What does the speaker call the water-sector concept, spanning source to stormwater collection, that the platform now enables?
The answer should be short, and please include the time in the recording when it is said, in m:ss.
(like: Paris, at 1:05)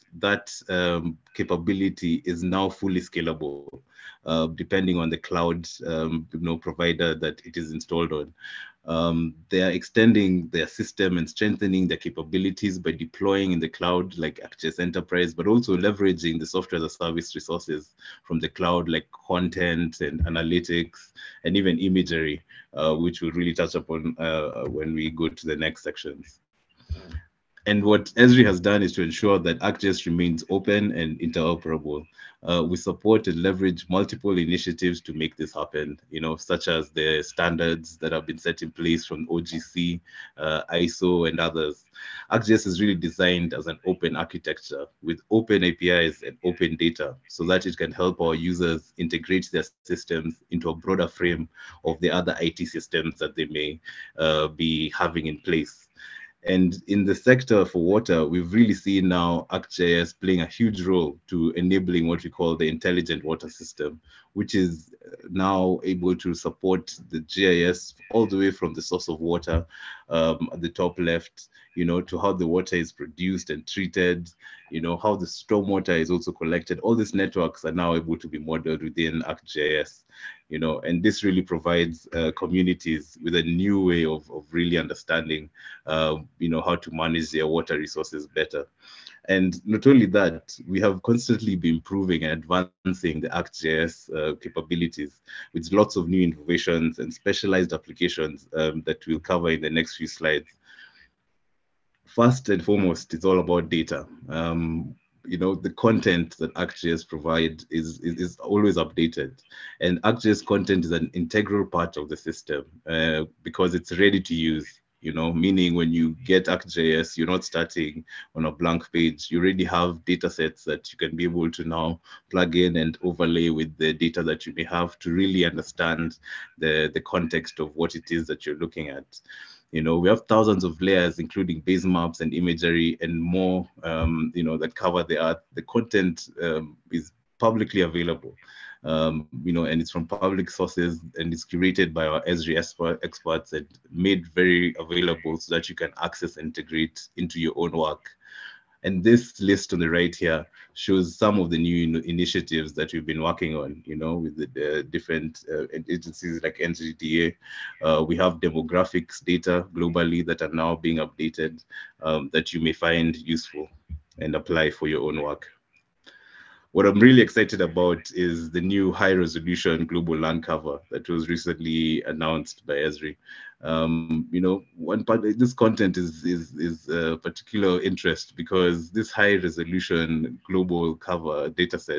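intelligent water system, at 1:02.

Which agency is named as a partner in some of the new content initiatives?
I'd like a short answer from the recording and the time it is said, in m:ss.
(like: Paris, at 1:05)
NGDA, at 2:36.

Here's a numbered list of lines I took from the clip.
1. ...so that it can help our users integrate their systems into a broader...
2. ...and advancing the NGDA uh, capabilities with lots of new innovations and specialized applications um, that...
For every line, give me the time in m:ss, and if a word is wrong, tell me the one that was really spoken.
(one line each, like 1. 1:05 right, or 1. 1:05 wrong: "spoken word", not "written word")
1. 0:47 right
2. 1:32 wrong: "ArcGIS", not "NGDA".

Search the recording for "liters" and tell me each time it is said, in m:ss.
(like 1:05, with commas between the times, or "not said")
not said.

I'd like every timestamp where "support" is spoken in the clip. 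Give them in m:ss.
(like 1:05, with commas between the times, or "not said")
0:32, 1:06.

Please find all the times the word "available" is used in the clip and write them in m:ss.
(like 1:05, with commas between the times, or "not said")
2:17, 2:24.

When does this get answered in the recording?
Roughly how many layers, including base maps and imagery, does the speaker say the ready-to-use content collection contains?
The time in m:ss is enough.
2:10.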